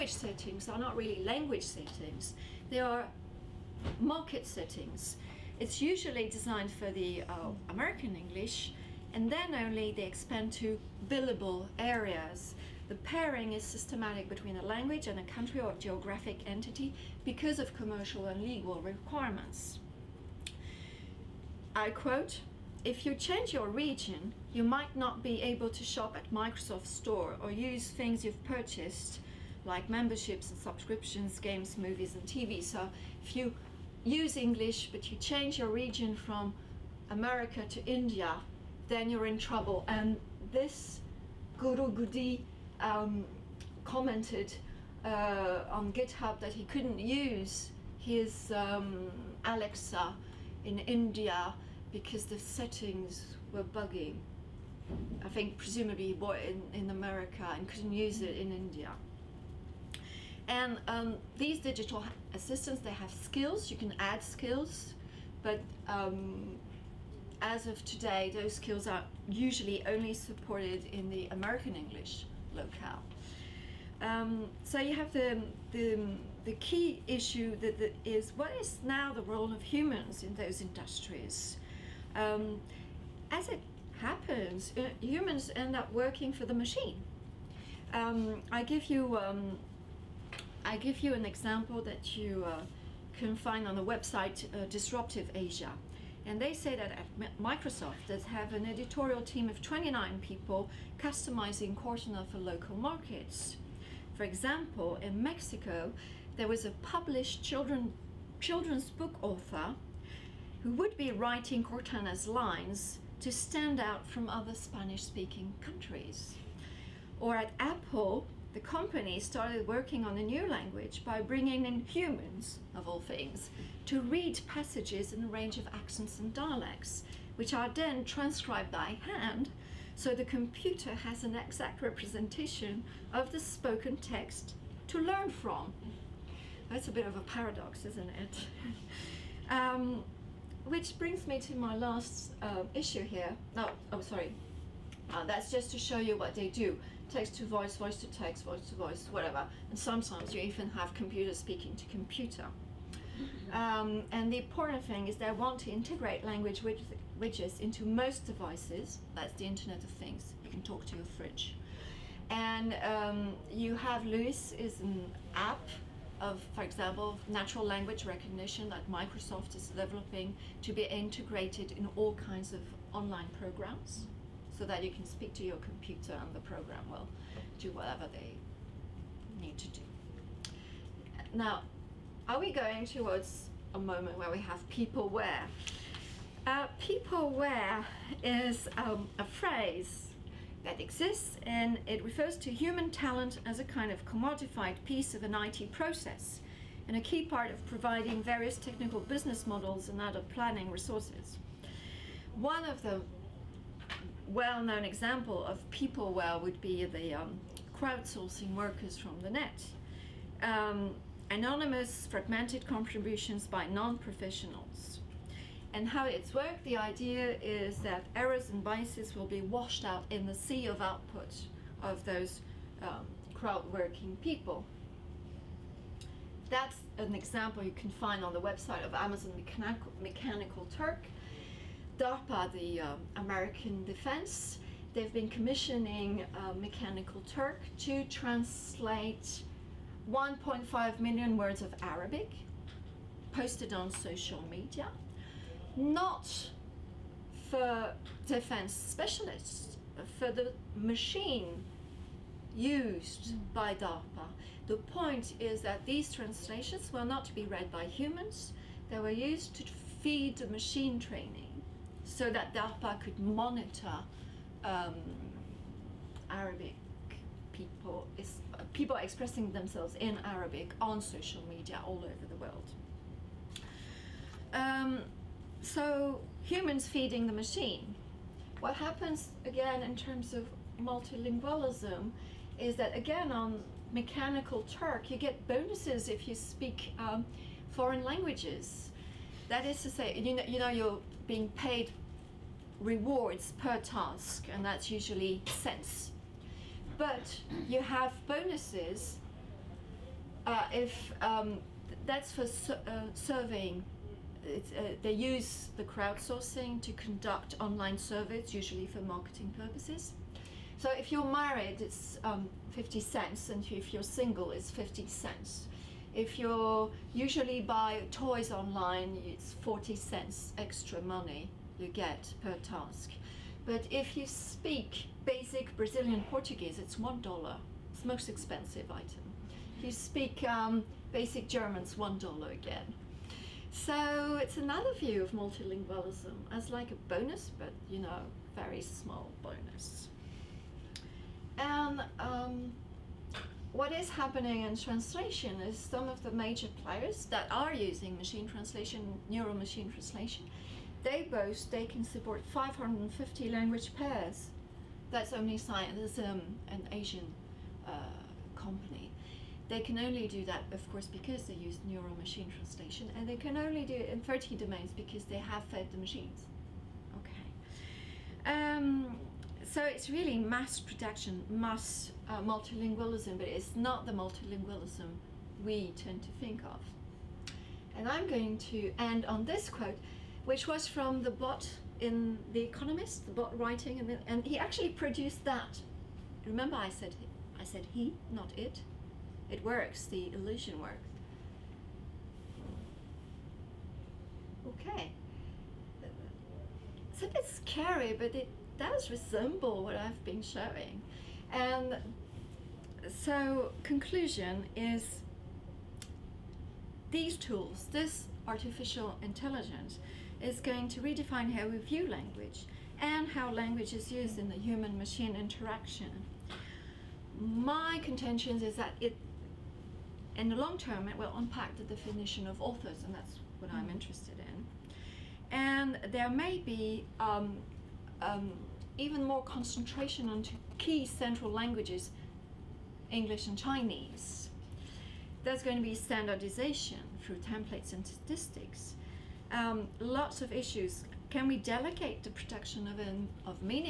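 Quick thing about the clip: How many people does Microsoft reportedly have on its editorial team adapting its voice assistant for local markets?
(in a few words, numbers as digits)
29.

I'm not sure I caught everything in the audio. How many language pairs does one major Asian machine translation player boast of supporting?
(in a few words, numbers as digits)
550.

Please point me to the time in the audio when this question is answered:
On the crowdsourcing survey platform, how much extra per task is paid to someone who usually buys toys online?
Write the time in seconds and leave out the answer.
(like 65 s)
319 s.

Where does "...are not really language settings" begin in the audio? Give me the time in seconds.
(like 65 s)
0 s.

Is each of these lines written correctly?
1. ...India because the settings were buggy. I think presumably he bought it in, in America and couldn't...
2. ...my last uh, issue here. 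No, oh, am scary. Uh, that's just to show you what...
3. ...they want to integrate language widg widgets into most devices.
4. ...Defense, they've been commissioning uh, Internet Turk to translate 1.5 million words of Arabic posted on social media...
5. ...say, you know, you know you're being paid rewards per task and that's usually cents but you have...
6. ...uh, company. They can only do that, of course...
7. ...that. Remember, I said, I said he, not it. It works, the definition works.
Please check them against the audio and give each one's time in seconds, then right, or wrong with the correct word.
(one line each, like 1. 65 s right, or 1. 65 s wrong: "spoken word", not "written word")
1. 50 s right
2. 141 s wrong: "sorry", not "scary"
3. 155 s right
4. 233 s wrong: "Mechanical", not "Internet"
5. 289 s right
6. 357 s right
7. 385 s wrong: "illusion", not "definition".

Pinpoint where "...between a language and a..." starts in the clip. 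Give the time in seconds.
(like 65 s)
14 s.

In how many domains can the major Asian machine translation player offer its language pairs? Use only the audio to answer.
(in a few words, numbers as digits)
30.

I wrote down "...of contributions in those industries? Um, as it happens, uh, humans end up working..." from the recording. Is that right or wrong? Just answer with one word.
wrong.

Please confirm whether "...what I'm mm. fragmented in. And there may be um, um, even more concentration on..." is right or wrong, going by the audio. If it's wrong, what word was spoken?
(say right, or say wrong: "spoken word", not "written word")
wrong: "interested", not "fragmented".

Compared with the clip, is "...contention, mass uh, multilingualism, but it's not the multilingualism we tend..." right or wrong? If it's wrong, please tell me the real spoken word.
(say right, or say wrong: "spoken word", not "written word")
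wrong: "production", not "contention".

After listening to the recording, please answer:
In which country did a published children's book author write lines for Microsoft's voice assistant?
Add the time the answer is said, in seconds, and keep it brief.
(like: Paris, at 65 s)
Mexico, at 105 s.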